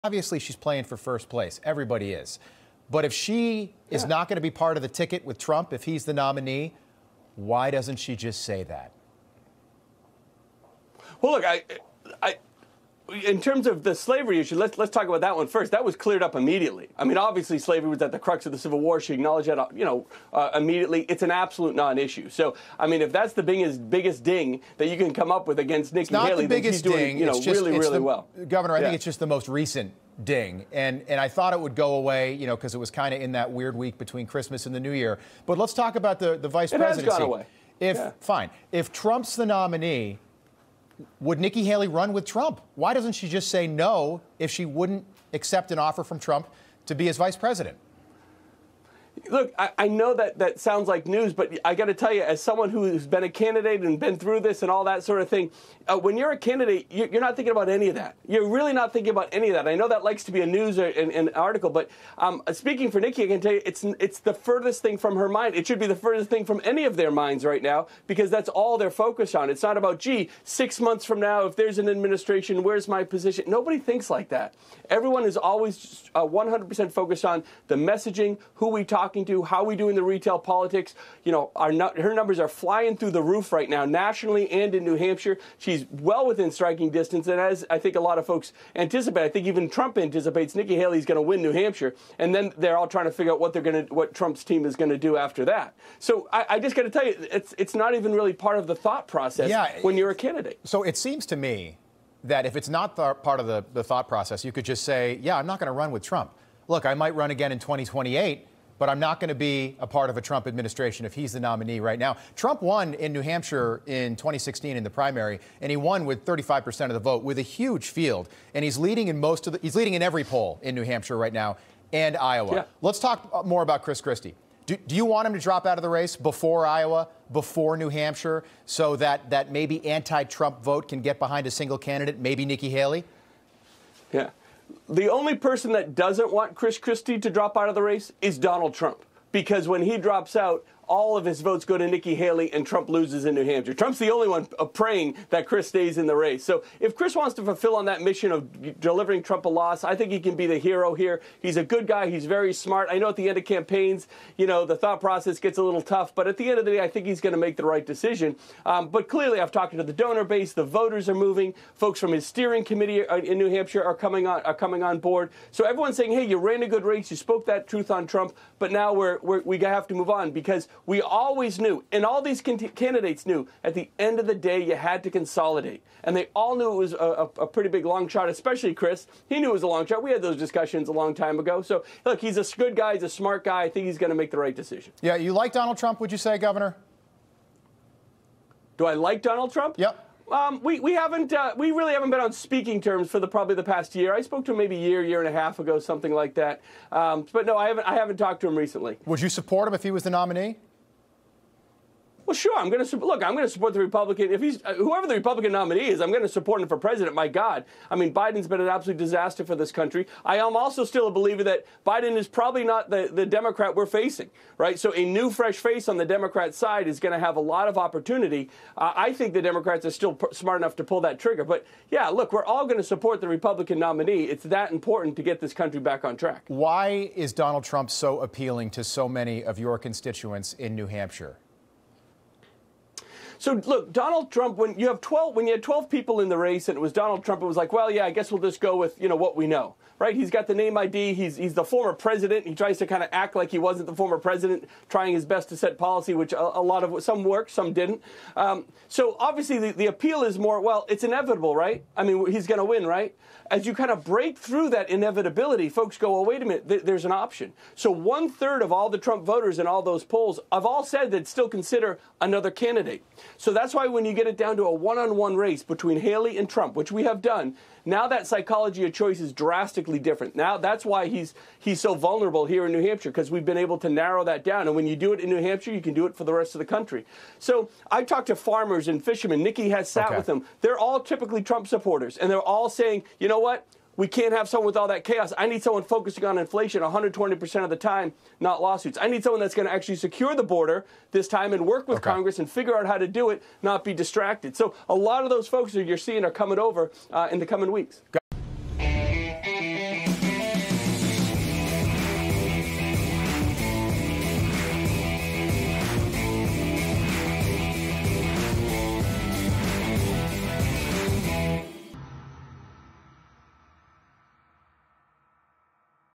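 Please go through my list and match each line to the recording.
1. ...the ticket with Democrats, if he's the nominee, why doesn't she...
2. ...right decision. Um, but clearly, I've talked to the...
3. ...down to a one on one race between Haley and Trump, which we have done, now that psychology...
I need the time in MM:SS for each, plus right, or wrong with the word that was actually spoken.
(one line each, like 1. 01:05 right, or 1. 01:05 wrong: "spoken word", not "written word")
1. 00:04 wrong: "Trump", not "Democrats"
2. 02:37 right
3. 04:24 right.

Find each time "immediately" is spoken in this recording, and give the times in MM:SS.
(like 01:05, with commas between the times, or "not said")
00:16, 00:20.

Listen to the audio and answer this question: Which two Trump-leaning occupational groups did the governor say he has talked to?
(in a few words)
farmers and fishermen.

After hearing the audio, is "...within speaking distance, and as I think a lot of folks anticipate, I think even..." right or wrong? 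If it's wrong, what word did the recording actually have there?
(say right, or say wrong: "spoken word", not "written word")
wrong: "striking", not "speaking".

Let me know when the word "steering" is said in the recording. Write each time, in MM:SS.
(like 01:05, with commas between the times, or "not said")
02:42.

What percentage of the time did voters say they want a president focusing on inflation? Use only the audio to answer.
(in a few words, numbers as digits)
120%.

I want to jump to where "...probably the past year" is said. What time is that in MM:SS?
03:13.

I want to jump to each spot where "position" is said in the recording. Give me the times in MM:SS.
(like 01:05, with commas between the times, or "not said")
01:13.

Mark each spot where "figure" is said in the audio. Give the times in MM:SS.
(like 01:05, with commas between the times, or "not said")
01:33, 04:52.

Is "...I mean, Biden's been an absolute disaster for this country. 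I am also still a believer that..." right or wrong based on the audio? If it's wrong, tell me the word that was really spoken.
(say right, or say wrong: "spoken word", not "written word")
right.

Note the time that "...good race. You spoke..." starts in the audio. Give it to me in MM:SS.
02:46.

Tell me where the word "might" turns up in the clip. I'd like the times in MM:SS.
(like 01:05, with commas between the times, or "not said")
01:46.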